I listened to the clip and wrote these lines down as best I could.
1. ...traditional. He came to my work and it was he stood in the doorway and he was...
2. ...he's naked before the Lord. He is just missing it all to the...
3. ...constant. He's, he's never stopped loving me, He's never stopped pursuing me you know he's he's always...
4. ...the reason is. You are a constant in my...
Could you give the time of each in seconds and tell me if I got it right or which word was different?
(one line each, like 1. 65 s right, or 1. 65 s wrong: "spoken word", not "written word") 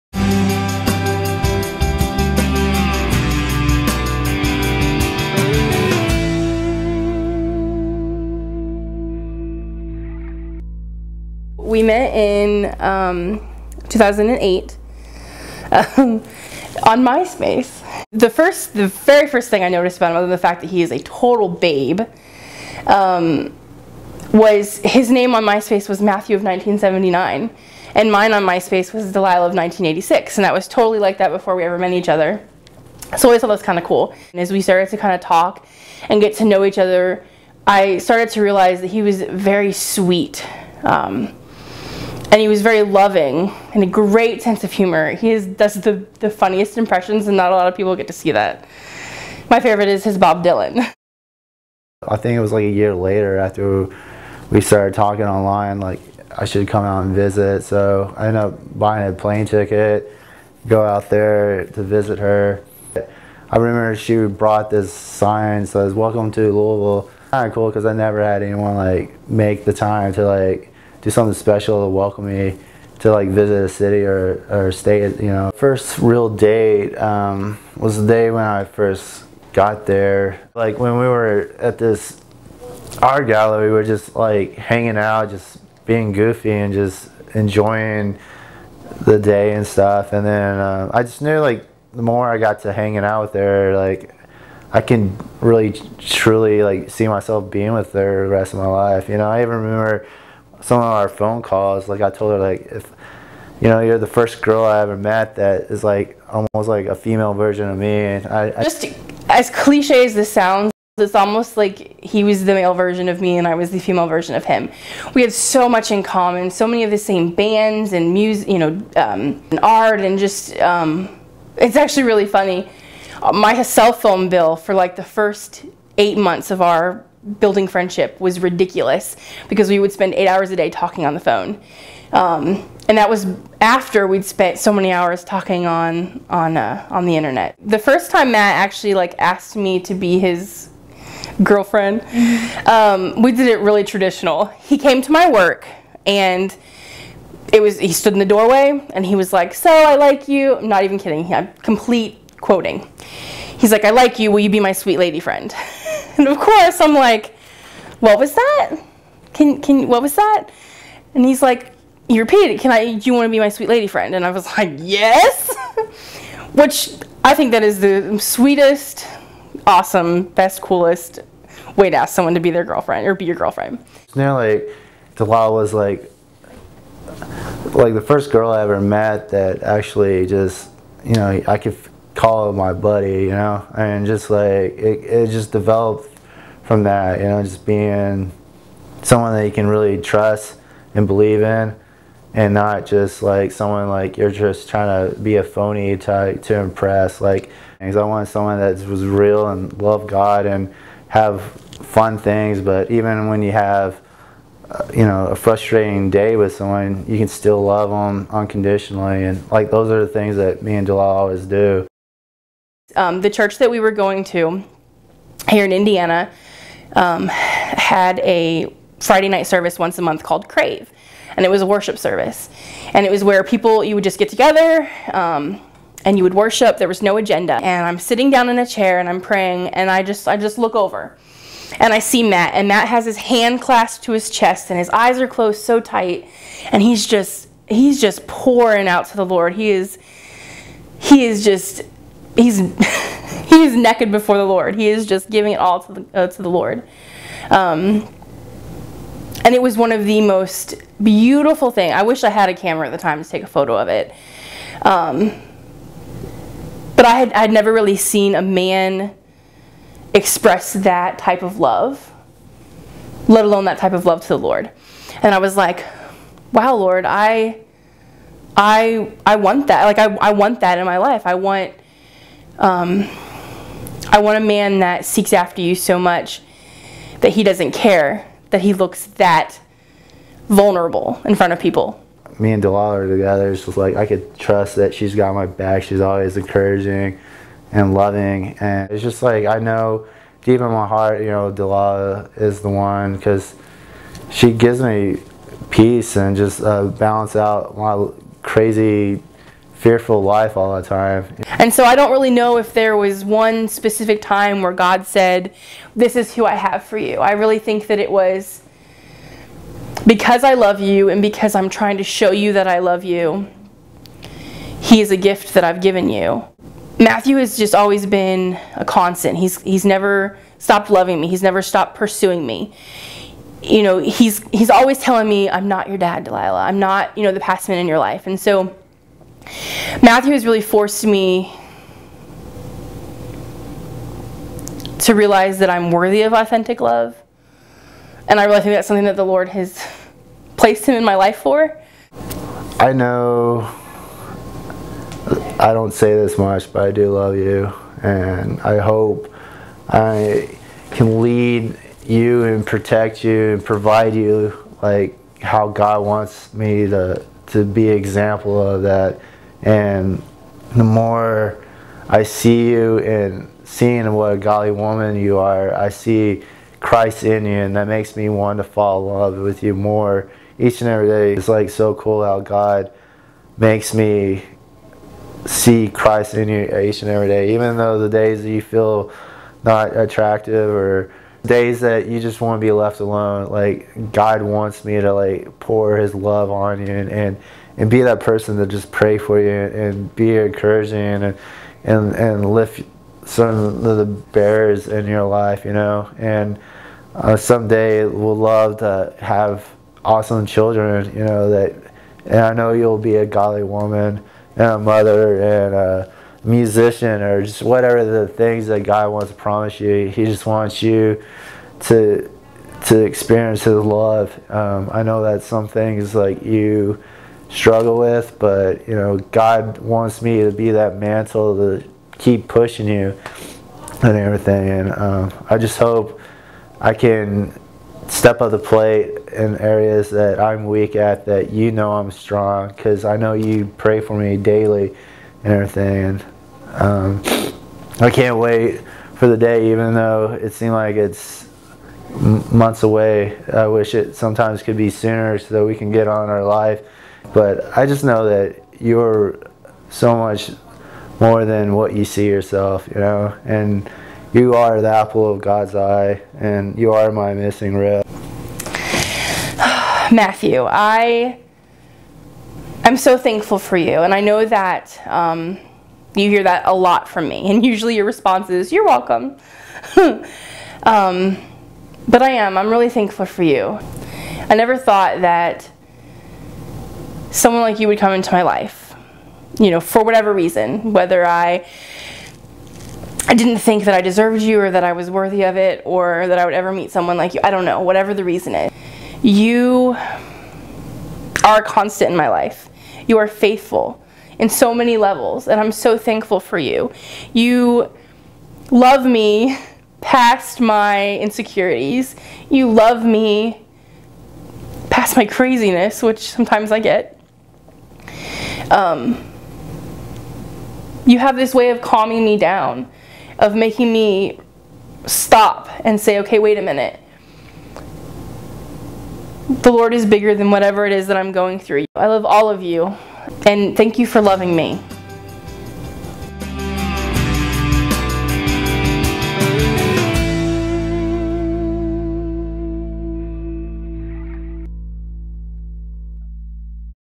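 1. 143 s right
2. 243 s wrong: "giving", not "missing"
3. 318 s right
4. 488 s right.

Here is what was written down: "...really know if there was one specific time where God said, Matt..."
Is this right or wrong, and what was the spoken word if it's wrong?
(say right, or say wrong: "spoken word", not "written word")
wrong: "This", not "Matt".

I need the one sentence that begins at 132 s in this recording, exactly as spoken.
Um, and that was after we'd spent so many hours talking on on uh, on the internet.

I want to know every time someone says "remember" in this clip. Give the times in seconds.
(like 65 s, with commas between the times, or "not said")
63 s, 99 s.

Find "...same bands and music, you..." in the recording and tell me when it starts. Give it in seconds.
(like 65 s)
116 s.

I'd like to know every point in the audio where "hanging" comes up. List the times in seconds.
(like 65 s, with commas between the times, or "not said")
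84 s, 92 s.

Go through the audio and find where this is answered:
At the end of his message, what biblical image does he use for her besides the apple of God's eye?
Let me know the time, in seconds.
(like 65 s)
457 s.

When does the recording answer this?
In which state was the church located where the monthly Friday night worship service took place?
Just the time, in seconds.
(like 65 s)
215 s.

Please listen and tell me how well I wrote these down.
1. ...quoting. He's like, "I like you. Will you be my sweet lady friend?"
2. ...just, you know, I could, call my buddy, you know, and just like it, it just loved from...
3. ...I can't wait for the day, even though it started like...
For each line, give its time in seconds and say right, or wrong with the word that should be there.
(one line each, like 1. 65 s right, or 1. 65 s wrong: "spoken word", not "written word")
1. 152 s right
2. 180 s wrong: "developed", not "loved"
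3. 437 s wrong: "seemed", not "started".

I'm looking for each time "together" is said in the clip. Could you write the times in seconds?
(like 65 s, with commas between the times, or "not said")
224 s, 283 s.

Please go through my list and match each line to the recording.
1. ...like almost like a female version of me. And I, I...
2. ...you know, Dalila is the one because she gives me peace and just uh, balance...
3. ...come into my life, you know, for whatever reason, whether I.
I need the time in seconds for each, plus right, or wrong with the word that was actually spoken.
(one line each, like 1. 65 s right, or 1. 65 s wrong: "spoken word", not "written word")
1. 105 s right
2. 291 s right
3. 477 s right.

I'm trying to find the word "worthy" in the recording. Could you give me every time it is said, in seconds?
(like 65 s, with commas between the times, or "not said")
335 s, 485 s.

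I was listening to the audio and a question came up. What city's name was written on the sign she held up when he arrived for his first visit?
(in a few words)
Louisville.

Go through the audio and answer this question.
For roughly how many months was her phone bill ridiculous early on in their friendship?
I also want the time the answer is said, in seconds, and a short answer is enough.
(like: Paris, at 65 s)
8, at 125 s.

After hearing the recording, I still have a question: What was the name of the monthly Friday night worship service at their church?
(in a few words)
Crave.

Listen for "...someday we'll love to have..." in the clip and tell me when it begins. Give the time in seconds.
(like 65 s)
397 s.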